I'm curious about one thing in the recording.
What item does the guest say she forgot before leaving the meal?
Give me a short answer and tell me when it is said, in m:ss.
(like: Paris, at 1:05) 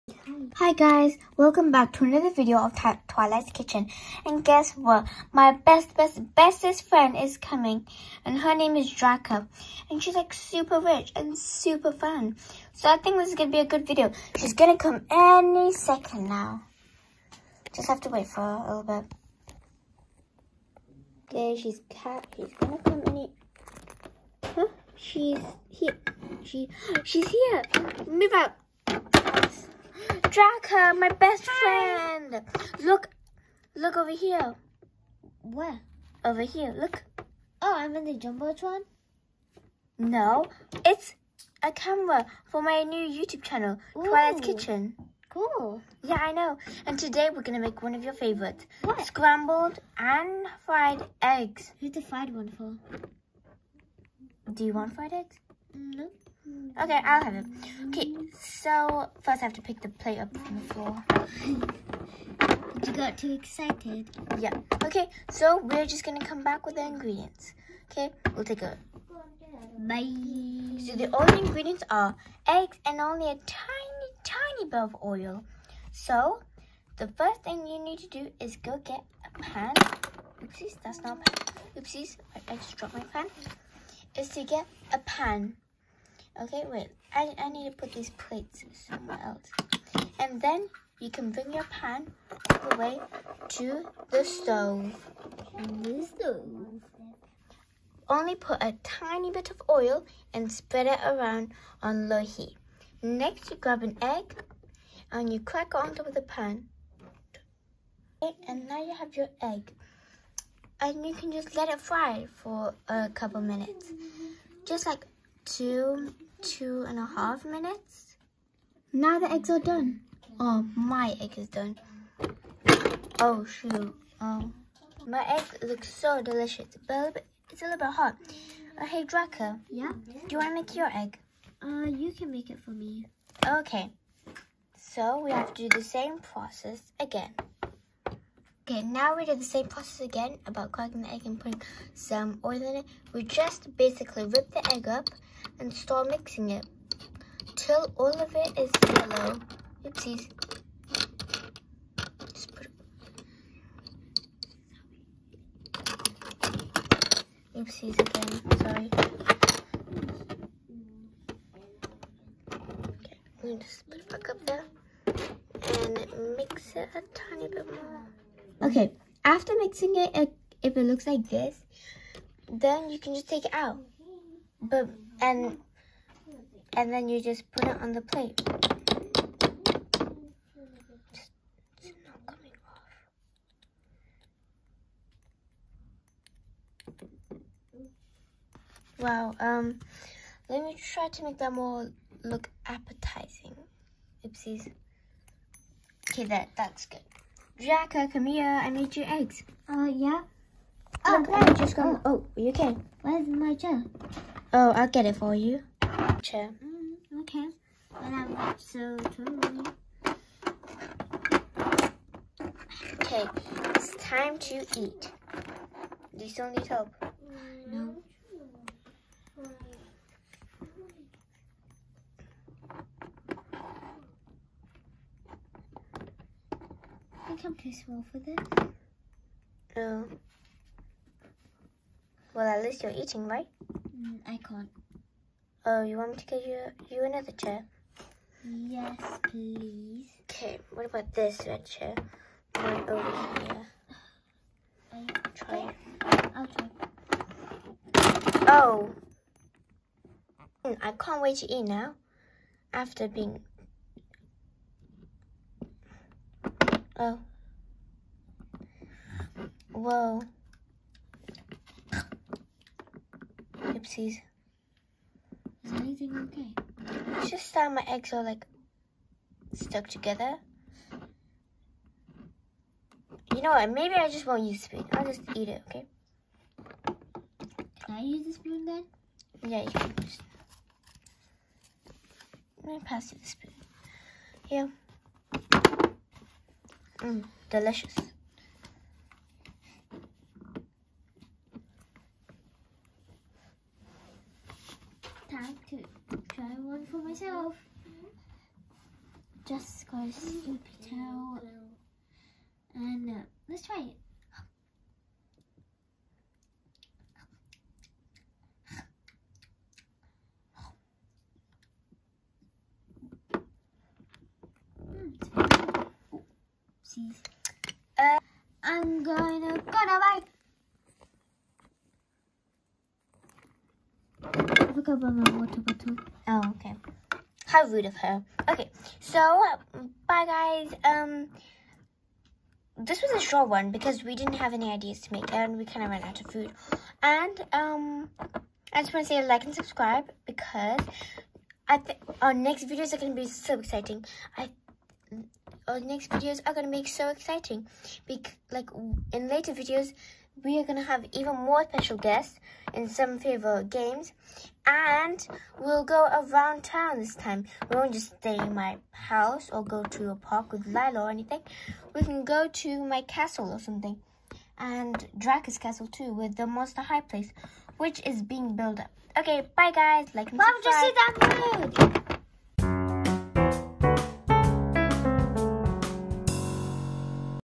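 Water bottle, at 5:25.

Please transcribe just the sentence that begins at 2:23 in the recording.
We just basically rip the egg up and start mixing it till all of it is yellow.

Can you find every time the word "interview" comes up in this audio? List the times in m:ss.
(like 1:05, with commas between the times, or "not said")
not said.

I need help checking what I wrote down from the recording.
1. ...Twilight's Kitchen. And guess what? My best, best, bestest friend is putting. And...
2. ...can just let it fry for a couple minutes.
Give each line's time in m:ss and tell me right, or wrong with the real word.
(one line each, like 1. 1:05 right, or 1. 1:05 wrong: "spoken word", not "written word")
1. 0:03 wrong: "coming", not "putting"
2. 1:51 right.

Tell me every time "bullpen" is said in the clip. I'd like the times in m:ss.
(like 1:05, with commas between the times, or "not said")
not said.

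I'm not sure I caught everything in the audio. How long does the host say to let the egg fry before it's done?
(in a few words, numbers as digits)
2 and a half minutes.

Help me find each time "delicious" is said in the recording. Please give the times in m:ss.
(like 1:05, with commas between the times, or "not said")
2:06, 4:47.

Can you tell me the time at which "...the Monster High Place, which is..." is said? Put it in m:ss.
6:06.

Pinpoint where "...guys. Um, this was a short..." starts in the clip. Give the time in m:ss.
5:30.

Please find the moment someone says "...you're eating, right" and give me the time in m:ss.
3:52.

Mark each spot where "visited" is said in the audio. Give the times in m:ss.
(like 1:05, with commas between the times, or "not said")
not said.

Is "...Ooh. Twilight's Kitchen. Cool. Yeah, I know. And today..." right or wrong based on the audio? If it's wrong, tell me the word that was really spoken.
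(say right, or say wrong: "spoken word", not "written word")
right.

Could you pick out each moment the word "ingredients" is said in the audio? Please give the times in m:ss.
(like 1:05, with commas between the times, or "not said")
1:06, 1:11.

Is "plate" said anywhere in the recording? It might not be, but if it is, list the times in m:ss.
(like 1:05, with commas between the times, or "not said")
0:59, 1:28, 2:58.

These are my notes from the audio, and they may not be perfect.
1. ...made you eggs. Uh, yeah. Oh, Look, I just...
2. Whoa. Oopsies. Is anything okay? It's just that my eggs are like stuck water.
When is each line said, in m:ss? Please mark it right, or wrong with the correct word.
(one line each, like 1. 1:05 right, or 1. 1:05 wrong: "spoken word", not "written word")
1. 3:18 right
2. 4:19 wrong: "together", not "water".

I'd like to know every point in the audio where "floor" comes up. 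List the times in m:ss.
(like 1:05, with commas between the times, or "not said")
1:00.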